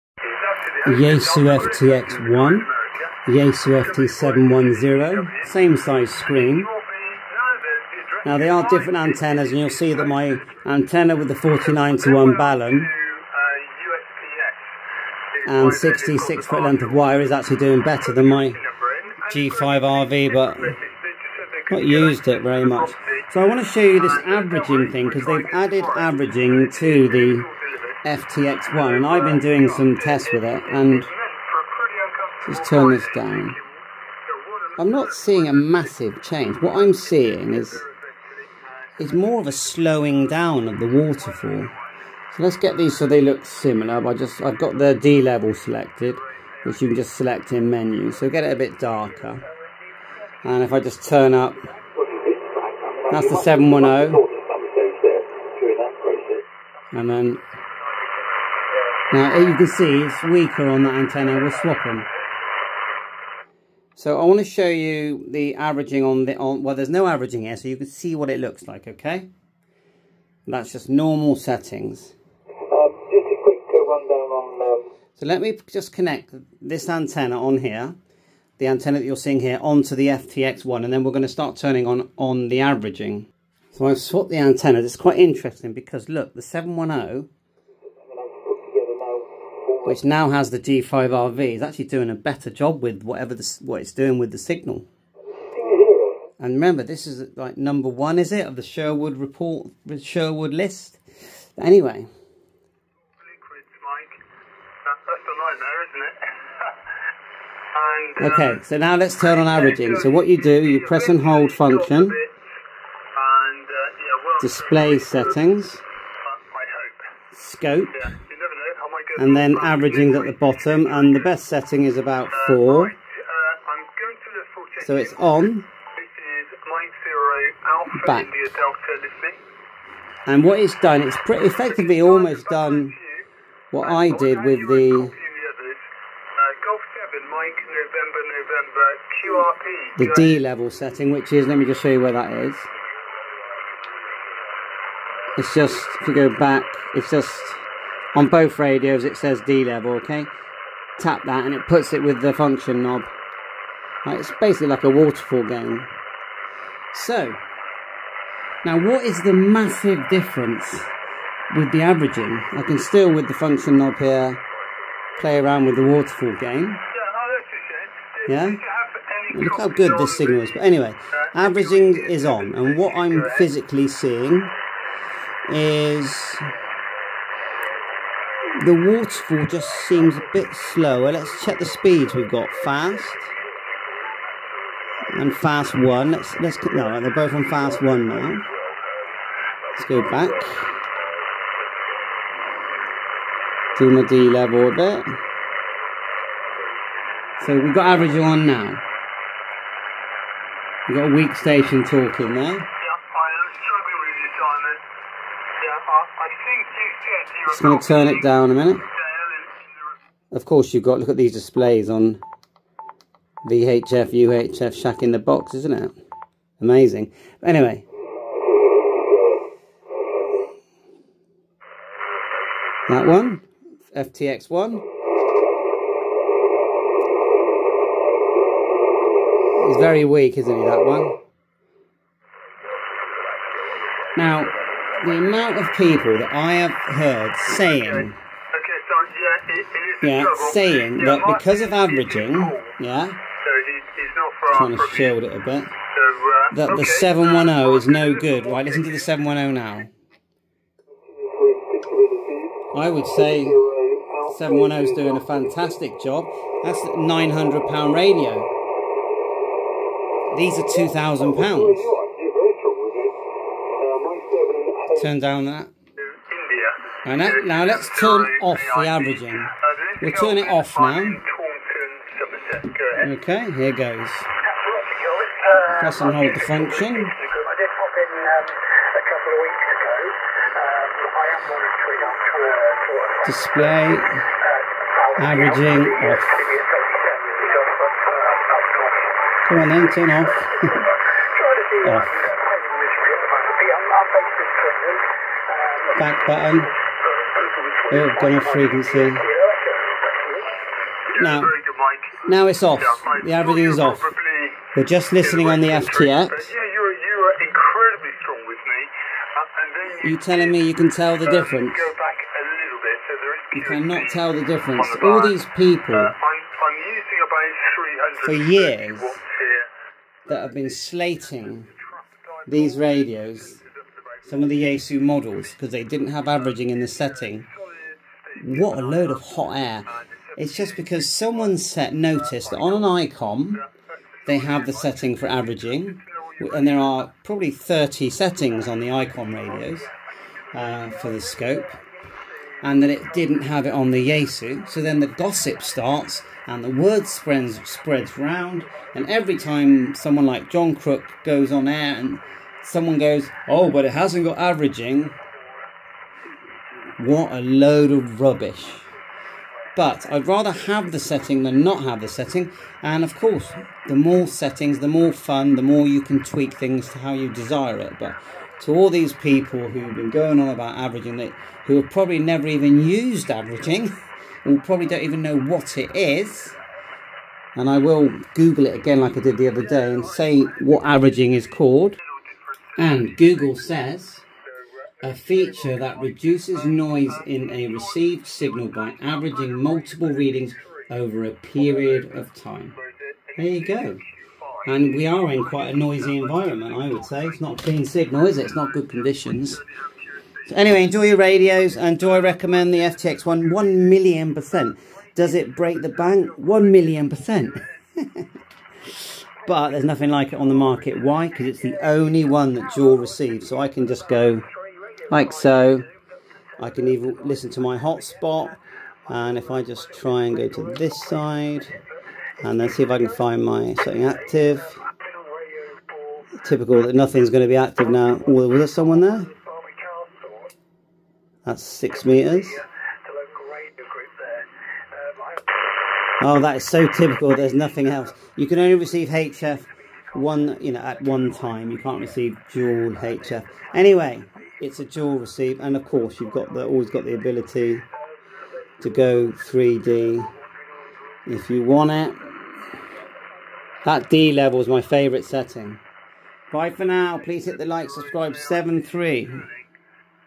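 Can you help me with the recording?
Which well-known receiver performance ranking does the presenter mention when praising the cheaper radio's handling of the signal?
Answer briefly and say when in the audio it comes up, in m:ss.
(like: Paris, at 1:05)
Sherwood list, at 1:40.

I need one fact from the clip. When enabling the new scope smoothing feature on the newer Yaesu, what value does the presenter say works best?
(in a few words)
4.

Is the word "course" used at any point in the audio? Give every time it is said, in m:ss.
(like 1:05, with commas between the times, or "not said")
3:30, 6:03, 7:25.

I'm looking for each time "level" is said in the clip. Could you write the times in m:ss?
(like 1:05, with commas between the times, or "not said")
0:45, 2:20, 2:29, 3:14, 7:34.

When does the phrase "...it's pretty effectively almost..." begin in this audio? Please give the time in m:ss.
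2:11.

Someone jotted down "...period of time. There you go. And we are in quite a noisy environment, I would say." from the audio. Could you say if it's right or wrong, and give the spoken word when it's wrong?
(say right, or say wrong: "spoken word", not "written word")
right.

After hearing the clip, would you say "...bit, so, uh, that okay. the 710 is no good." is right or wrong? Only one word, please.
right.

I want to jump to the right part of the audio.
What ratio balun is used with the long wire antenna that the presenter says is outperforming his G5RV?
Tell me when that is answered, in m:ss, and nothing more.
0:11.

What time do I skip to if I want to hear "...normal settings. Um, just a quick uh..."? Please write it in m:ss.
1:10.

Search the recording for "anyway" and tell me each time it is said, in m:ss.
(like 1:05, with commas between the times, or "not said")
1:41, 2:50, 3:37, 6:40, 7:23.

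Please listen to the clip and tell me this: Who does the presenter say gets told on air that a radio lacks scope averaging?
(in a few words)
John Crook.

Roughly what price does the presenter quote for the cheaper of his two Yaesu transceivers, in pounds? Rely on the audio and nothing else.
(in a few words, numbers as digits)
£900.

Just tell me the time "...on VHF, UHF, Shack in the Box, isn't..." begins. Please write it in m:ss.
3:31.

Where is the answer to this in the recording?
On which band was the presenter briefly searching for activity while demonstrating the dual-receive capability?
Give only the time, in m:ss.
7:11.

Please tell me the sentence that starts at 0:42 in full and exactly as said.
So let's get these so they look similar.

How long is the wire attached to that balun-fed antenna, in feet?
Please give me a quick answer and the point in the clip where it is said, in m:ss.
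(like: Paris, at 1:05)
66 feet, at 0:15.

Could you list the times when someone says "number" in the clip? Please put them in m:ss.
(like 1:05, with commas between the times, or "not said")
1:37.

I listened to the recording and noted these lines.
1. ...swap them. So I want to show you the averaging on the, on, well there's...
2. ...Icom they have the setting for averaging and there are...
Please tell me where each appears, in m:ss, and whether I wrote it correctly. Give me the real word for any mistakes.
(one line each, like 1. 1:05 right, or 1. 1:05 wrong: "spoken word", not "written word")
1. 1:01 right
2. 5:32 right.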